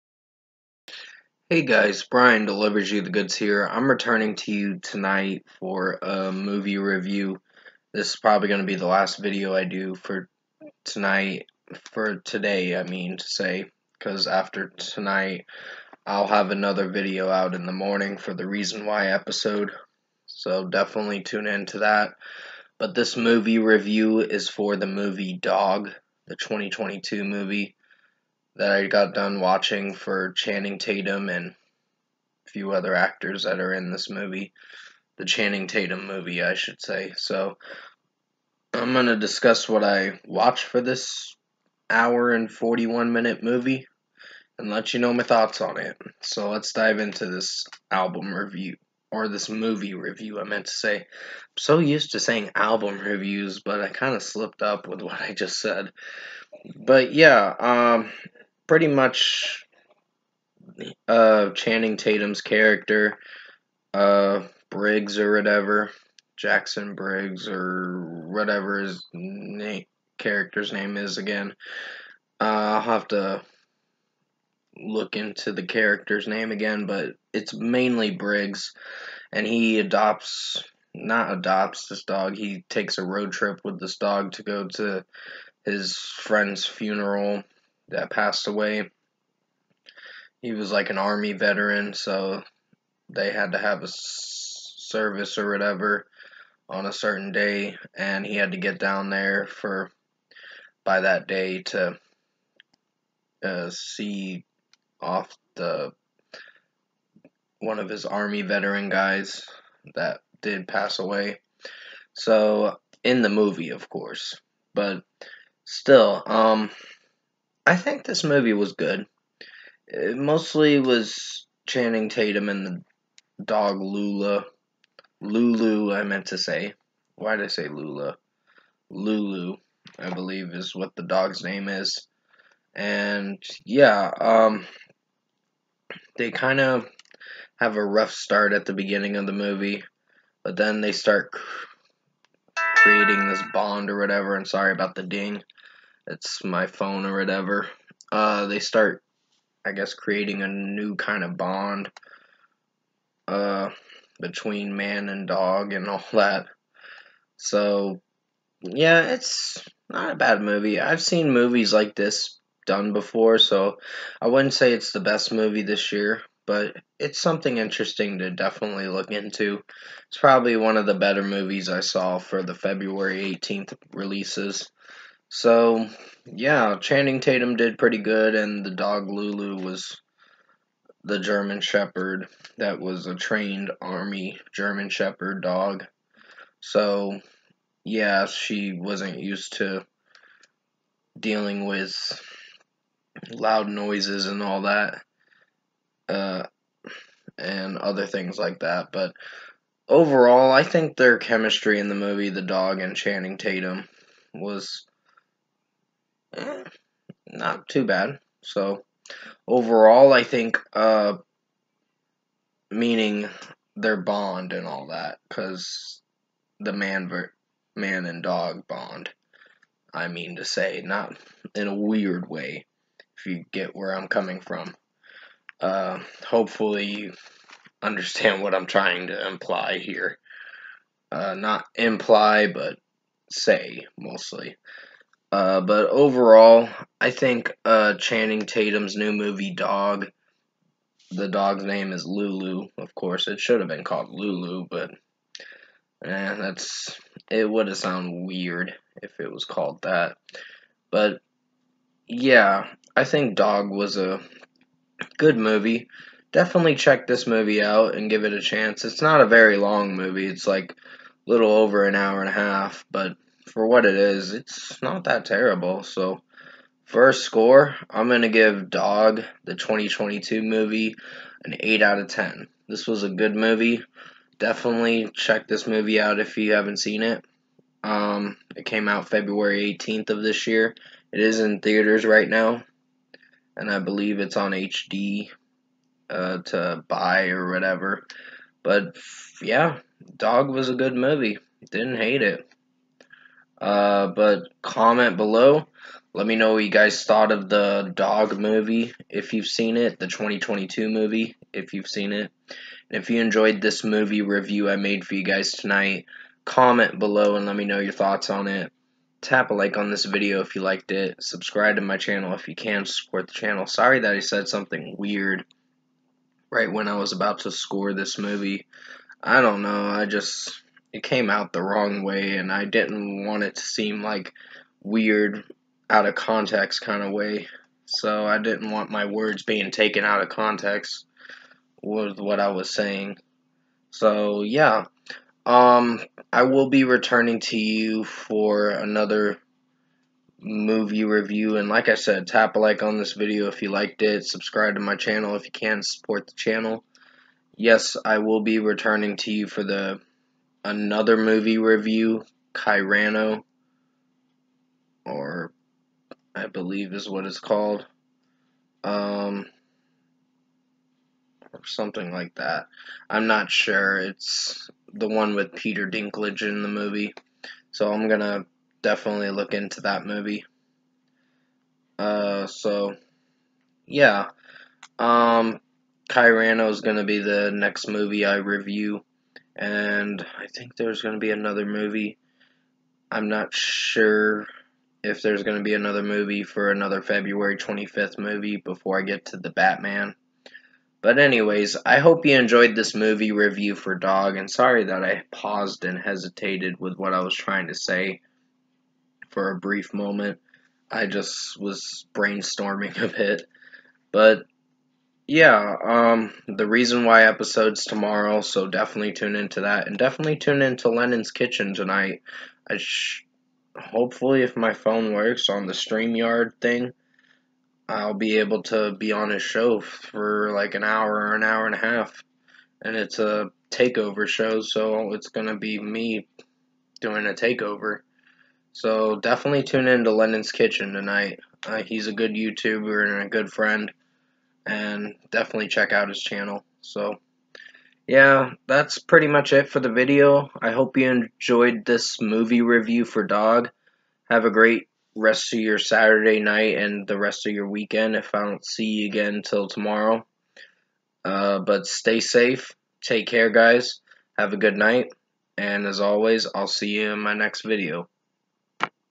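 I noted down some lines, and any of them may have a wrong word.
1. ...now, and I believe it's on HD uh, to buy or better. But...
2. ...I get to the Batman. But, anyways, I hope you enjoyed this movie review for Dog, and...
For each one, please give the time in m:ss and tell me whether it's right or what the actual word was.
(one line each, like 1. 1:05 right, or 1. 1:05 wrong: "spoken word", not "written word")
1. 4:42 wrong: "whatever", not "better"
2. 6:28 right.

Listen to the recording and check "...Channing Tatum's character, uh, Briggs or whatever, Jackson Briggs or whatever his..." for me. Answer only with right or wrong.
right.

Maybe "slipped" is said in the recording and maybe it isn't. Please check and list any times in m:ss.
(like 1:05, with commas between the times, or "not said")
0:54.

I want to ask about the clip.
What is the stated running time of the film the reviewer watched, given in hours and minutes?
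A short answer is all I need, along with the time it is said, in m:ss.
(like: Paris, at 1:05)
1 hour 41 minutes, at 0:41.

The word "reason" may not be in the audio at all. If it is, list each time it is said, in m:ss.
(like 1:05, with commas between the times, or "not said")
0:18, 6:46.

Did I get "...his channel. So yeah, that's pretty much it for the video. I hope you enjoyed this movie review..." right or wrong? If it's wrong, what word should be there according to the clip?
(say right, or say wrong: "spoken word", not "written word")
right.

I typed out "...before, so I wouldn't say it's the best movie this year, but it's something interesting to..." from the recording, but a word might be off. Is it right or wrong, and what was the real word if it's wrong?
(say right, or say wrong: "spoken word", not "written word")
right.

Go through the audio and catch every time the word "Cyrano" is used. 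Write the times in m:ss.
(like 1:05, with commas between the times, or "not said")
5:52, 6:16.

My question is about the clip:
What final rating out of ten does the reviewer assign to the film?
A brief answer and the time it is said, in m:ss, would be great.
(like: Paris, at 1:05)
8, at 4:31.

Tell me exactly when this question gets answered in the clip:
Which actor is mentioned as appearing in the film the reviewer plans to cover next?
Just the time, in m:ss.
6:05.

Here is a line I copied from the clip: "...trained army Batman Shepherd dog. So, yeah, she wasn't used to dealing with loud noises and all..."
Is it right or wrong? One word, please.
wrong.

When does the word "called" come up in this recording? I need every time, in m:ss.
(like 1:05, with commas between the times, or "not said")
4:03, 4:09, 5:57.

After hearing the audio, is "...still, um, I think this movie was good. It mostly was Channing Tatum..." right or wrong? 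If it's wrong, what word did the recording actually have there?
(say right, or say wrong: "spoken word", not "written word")
right.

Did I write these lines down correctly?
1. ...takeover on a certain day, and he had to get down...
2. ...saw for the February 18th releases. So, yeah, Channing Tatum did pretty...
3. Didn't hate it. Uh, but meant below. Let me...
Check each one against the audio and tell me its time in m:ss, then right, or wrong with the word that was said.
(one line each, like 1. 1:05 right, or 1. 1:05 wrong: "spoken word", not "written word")
1. 1:35 wrong: "whatever", not "takeover"
2. 2:51 right
3. 4:51 wrong: "comment", not "meant".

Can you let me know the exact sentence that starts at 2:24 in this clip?
And sorry about the ding it's my phone or whatever.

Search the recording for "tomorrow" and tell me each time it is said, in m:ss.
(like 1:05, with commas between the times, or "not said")
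6:47, 7:29.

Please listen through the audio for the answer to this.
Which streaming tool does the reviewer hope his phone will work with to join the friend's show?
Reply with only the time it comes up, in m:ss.
6:55.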